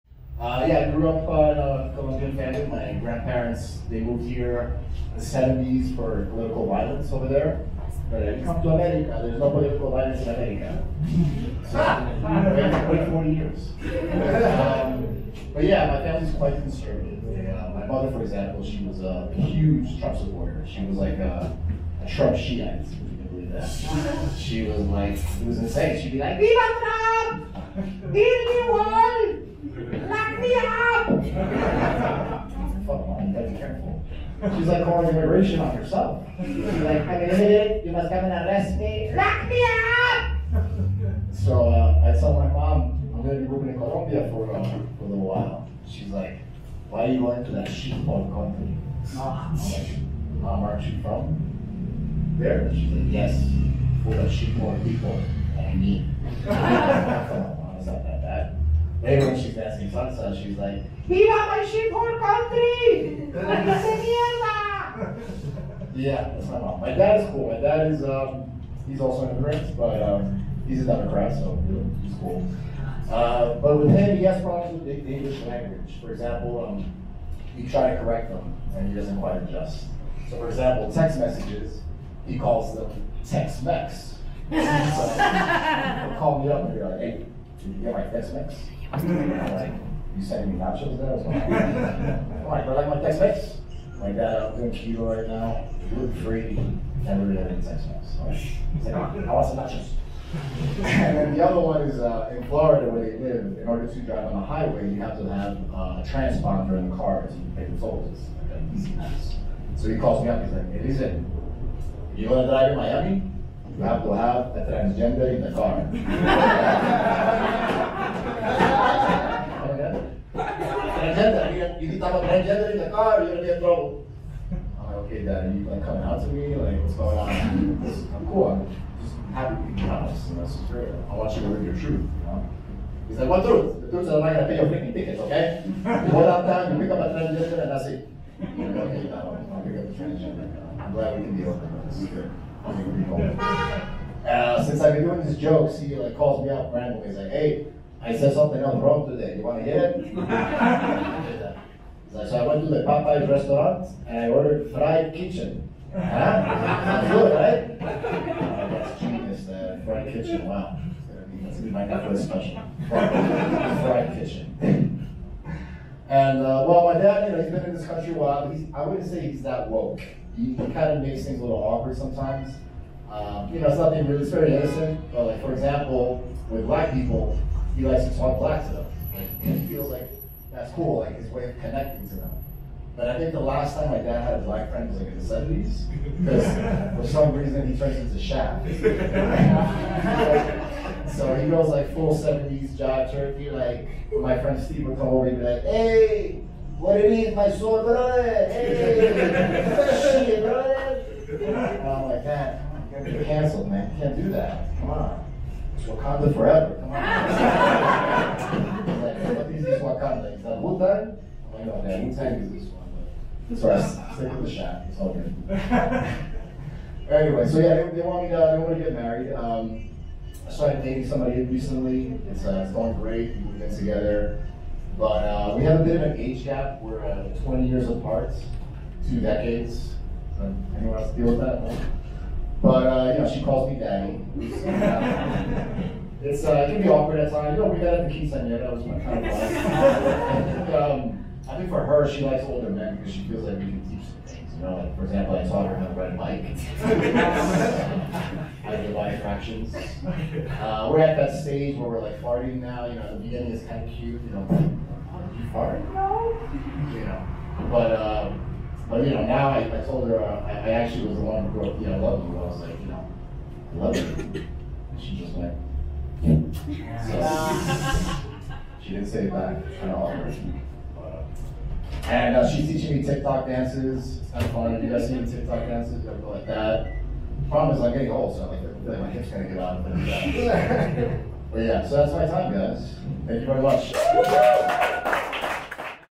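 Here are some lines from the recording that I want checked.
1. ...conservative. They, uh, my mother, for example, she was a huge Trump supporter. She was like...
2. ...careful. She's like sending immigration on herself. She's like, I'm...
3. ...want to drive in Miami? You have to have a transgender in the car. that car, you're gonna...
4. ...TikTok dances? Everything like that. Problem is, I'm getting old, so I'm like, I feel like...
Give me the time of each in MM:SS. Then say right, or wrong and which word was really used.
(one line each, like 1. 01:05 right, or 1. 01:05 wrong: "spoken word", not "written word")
1. 00:16 right
2. 00:33 wrong: "calling", not "sending"
3. 01:52 right
4. 04:35 right.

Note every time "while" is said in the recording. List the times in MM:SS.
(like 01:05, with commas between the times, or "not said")
00:45, 02:48.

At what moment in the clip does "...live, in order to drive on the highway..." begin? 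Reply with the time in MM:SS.
01:43.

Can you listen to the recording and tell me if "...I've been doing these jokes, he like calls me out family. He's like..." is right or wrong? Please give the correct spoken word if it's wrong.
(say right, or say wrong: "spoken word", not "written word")
wrong: "randomly", not "family".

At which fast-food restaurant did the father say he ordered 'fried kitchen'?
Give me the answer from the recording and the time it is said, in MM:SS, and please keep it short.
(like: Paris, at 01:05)
Popeyes, at 02:32.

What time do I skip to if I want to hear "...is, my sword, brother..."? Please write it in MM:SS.
03:17.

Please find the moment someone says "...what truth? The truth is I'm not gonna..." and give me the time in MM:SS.
02:13.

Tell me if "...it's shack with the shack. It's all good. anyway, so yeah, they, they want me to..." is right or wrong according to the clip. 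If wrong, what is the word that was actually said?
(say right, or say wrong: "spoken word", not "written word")
wrong: "stick", not "shack".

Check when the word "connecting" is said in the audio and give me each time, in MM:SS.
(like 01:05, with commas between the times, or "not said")
03:01.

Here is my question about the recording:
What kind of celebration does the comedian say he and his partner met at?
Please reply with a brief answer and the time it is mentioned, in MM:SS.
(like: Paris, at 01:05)
quinceanera, at 03:58.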